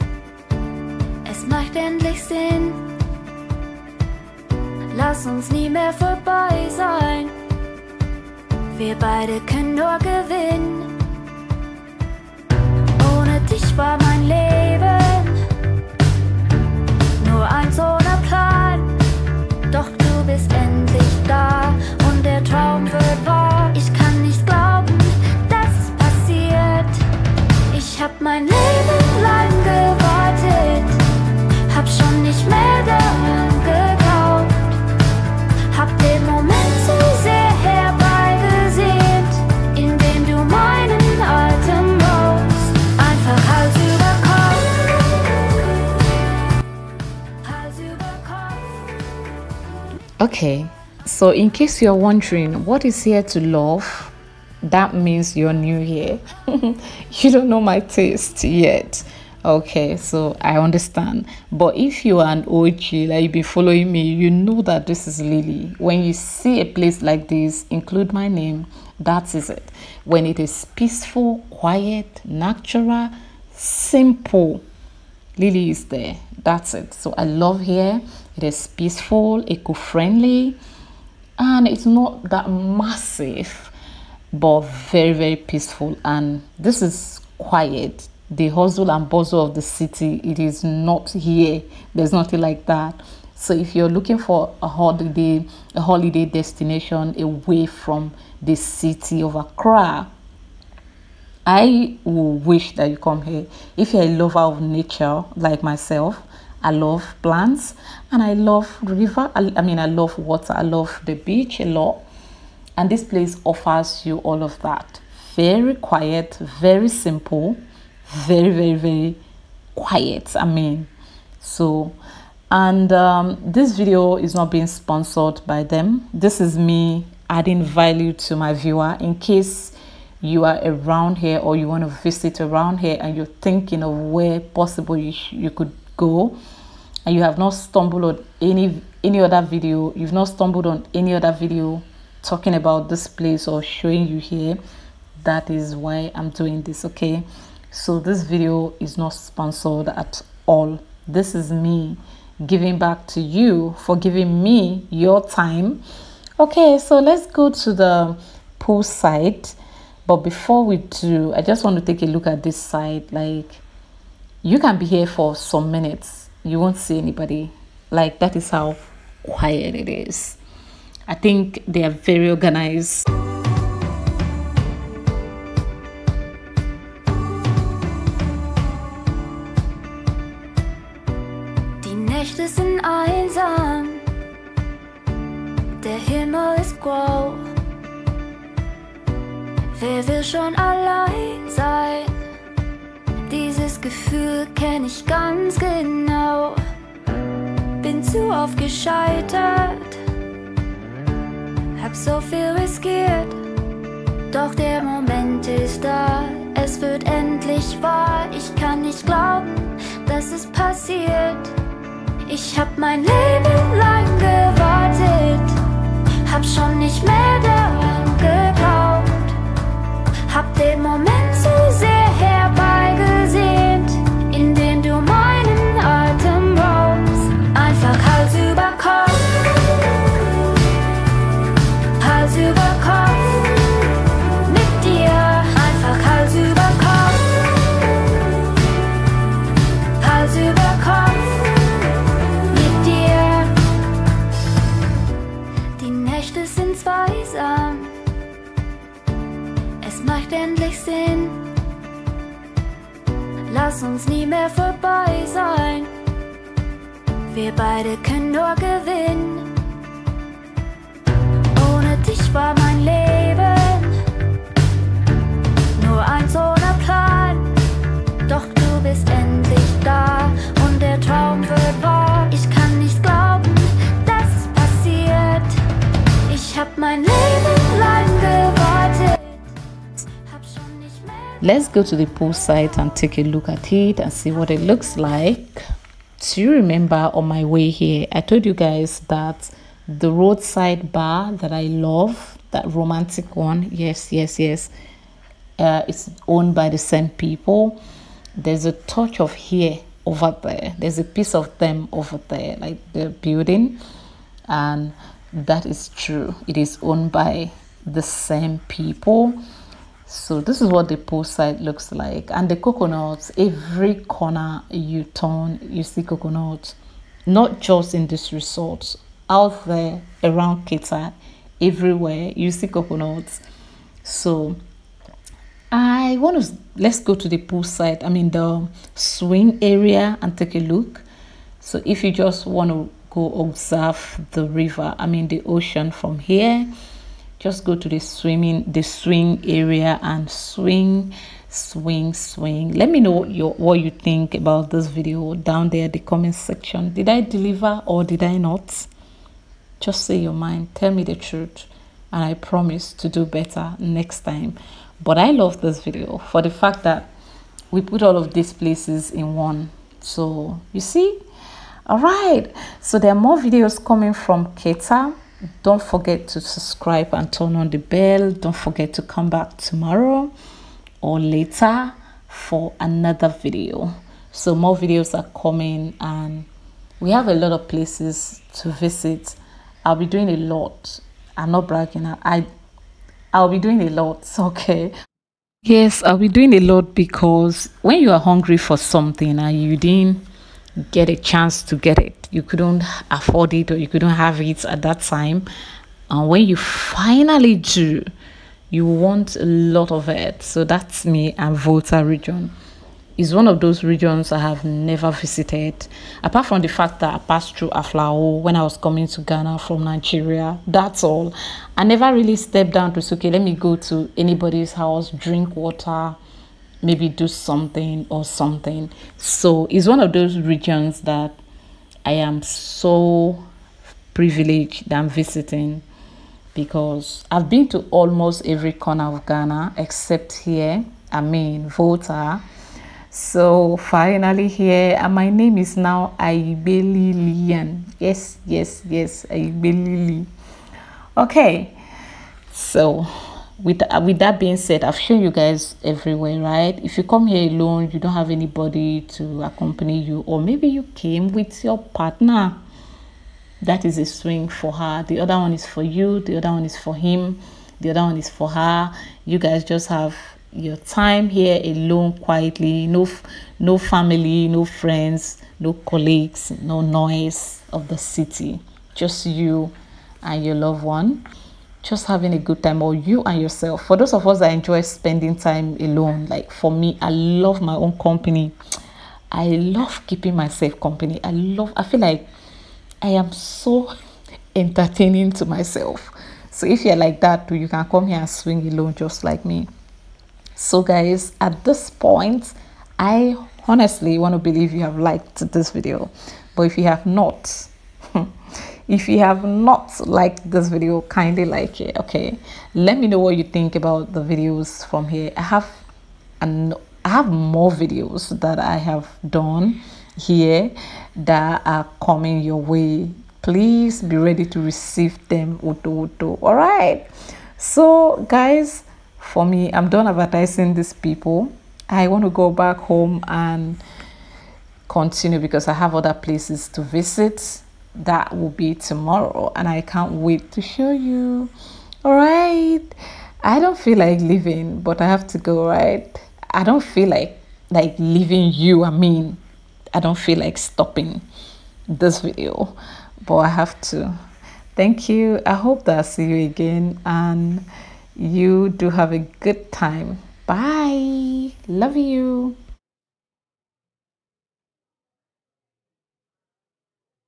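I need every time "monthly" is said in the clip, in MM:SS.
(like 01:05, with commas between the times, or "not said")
not said.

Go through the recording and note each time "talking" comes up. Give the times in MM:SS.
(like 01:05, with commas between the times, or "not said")
02:22.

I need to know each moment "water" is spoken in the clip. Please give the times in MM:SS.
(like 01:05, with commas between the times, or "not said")
01:50, 06:55.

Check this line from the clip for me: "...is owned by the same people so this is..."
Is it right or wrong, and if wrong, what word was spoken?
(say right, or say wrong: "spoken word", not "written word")
right.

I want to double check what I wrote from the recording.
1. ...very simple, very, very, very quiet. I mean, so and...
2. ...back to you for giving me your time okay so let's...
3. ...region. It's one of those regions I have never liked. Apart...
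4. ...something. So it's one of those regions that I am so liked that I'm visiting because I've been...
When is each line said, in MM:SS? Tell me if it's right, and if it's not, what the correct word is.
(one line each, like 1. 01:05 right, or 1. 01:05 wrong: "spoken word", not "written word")
1. 01:56 right
2. 02:32 right
3. 06:42 wrong: "visited", not "liked"
4. 06:58 wrong: "privileged", not "liked".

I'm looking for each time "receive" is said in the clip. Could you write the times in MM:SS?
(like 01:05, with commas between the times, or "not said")
08:34.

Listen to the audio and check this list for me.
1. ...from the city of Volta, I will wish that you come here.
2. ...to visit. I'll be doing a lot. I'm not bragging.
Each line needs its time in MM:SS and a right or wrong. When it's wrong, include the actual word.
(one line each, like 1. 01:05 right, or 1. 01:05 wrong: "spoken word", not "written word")
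1. 01:37 wrong: "Accra", not "Volta"
2. 06:18 right.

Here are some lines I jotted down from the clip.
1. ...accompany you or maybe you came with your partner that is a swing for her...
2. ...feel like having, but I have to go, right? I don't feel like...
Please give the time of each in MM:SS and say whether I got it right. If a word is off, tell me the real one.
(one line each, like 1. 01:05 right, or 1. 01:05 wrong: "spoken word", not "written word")
1. 07:29 right
2. 08:53 wrong: "leaving", not "having".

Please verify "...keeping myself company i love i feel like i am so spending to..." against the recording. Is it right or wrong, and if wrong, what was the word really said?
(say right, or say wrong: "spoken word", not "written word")
wrong: "entertaining", not "spending".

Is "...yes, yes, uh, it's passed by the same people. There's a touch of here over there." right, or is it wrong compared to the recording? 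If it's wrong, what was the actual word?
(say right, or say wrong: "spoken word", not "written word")
wrong: "owned", not "passed".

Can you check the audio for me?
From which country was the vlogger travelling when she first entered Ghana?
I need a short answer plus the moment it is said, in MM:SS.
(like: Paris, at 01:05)
Nigeria, at 06:49.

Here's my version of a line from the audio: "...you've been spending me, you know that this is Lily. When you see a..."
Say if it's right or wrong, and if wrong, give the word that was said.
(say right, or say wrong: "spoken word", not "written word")
wrong: "following", not "spending".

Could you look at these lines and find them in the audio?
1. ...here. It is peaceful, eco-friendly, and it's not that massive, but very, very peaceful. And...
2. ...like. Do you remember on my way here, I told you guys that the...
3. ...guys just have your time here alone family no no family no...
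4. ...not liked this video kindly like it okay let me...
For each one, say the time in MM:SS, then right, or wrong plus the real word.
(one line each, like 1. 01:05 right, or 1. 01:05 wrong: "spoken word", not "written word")
1. 01:17 right
2. 04:44 right
3. 07:39 wrong: "quietly", not "family"
4. 08:19 right.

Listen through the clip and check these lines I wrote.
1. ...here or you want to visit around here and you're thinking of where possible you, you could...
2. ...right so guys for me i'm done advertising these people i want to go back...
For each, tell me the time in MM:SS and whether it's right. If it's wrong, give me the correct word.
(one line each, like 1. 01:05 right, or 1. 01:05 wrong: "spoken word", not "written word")
1. 02:11 right
2. 08:36 right.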